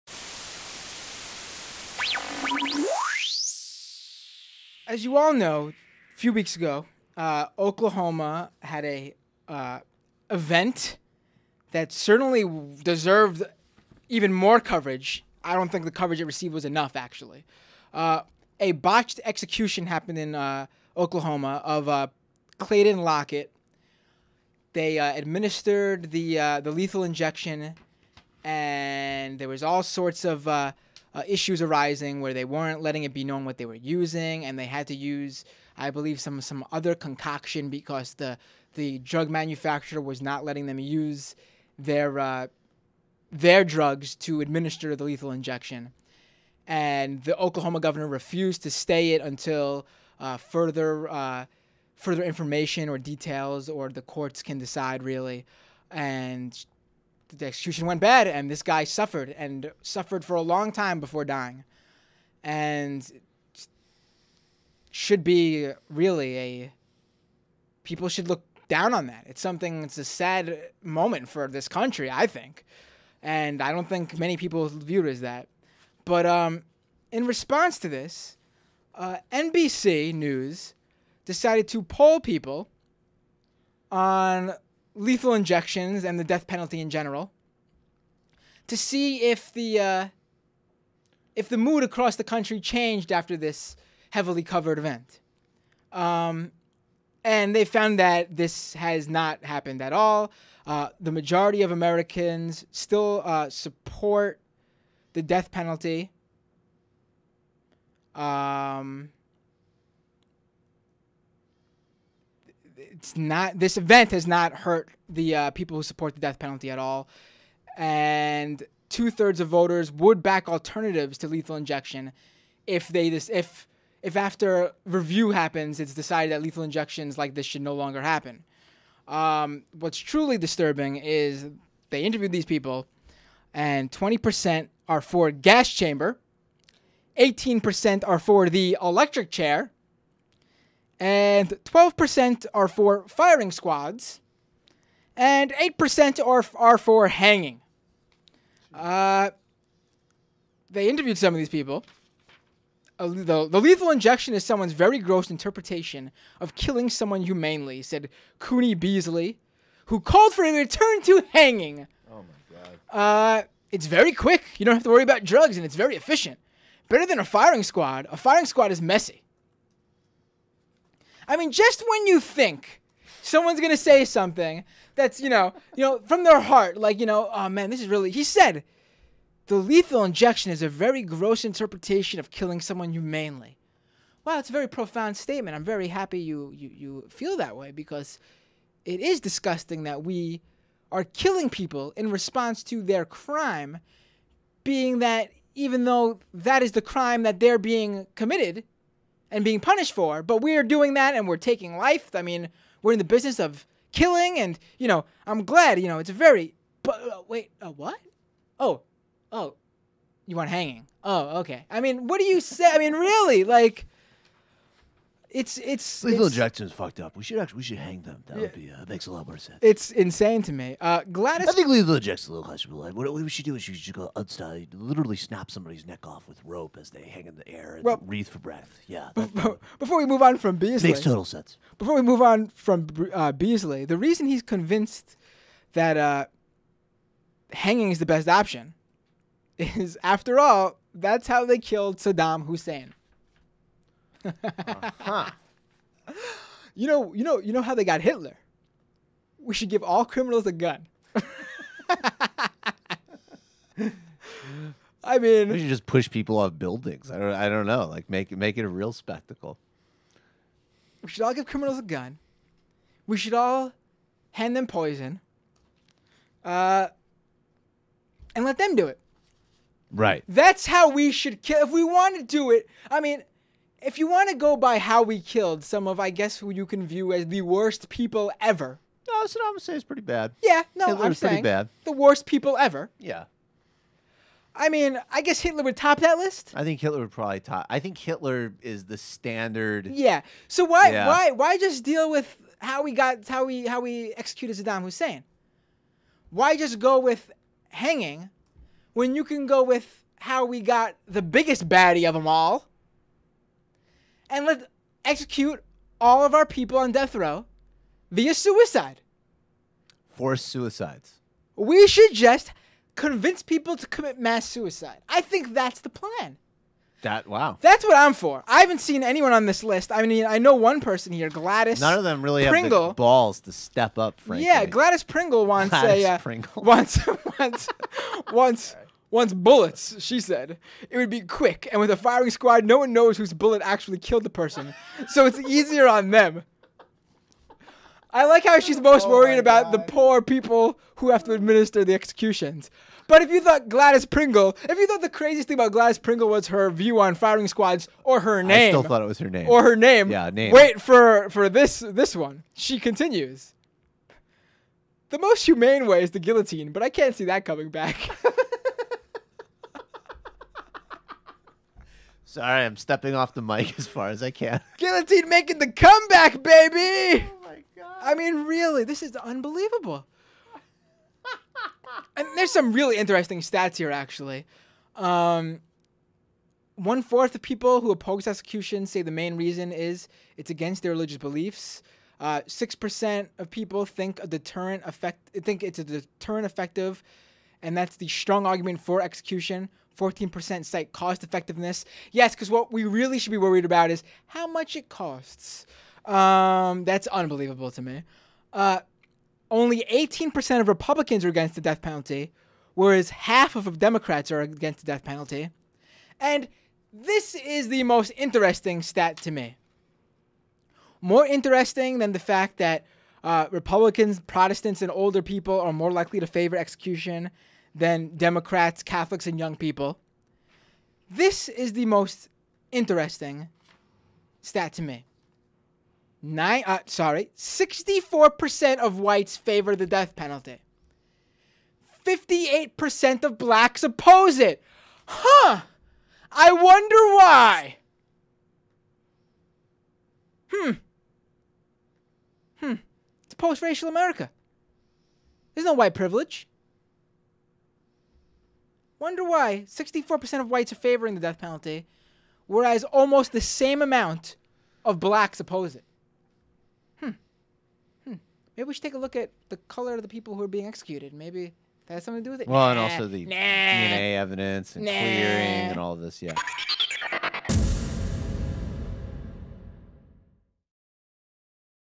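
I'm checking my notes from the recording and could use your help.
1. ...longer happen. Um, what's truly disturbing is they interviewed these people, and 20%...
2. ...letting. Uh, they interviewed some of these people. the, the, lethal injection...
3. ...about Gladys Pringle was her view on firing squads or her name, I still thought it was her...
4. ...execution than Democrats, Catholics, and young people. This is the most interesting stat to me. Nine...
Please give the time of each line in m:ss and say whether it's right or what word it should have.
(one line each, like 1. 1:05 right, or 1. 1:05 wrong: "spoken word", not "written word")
1. 2:07 right
2. 2:27 wrong: "hanging", not "letting"
3. 5:45 right
4. 6:56 right.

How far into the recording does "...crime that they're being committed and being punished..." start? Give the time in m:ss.
3:16.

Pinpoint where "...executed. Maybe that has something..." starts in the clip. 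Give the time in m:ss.
7:40.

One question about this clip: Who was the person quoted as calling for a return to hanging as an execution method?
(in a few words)
Cooney Beasley.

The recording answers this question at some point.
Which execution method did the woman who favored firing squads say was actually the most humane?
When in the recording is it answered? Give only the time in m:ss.
5:56.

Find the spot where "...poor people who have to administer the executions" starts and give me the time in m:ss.
5:39.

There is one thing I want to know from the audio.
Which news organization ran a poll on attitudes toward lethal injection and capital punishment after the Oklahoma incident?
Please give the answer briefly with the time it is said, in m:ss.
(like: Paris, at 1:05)
NBC News, at 1:19.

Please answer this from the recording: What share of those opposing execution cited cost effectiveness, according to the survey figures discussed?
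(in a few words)
14%.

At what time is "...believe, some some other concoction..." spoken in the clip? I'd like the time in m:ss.
0:35.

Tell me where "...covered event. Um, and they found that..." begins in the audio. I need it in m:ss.
1:34.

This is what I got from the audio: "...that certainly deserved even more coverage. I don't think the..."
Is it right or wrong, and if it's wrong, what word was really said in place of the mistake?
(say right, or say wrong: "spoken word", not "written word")
right.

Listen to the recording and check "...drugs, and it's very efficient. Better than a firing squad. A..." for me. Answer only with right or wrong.
right.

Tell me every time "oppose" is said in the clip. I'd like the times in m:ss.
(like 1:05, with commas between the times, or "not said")
6:17, 7:13, 7:35.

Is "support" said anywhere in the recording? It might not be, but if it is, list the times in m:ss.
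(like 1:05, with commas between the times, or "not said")
1:43, 1:55.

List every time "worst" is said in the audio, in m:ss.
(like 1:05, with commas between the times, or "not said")
4:37, 4:41.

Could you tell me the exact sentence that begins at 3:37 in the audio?
We should actually we should hang them.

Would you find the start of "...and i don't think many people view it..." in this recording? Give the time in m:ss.
1:13.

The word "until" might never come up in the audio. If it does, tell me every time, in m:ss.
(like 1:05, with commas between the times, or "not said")
0:49.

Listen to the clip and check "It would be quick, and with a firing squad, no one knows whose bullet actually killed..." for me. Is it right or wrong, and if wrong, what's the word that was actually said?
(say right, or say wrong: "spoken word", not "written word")
right.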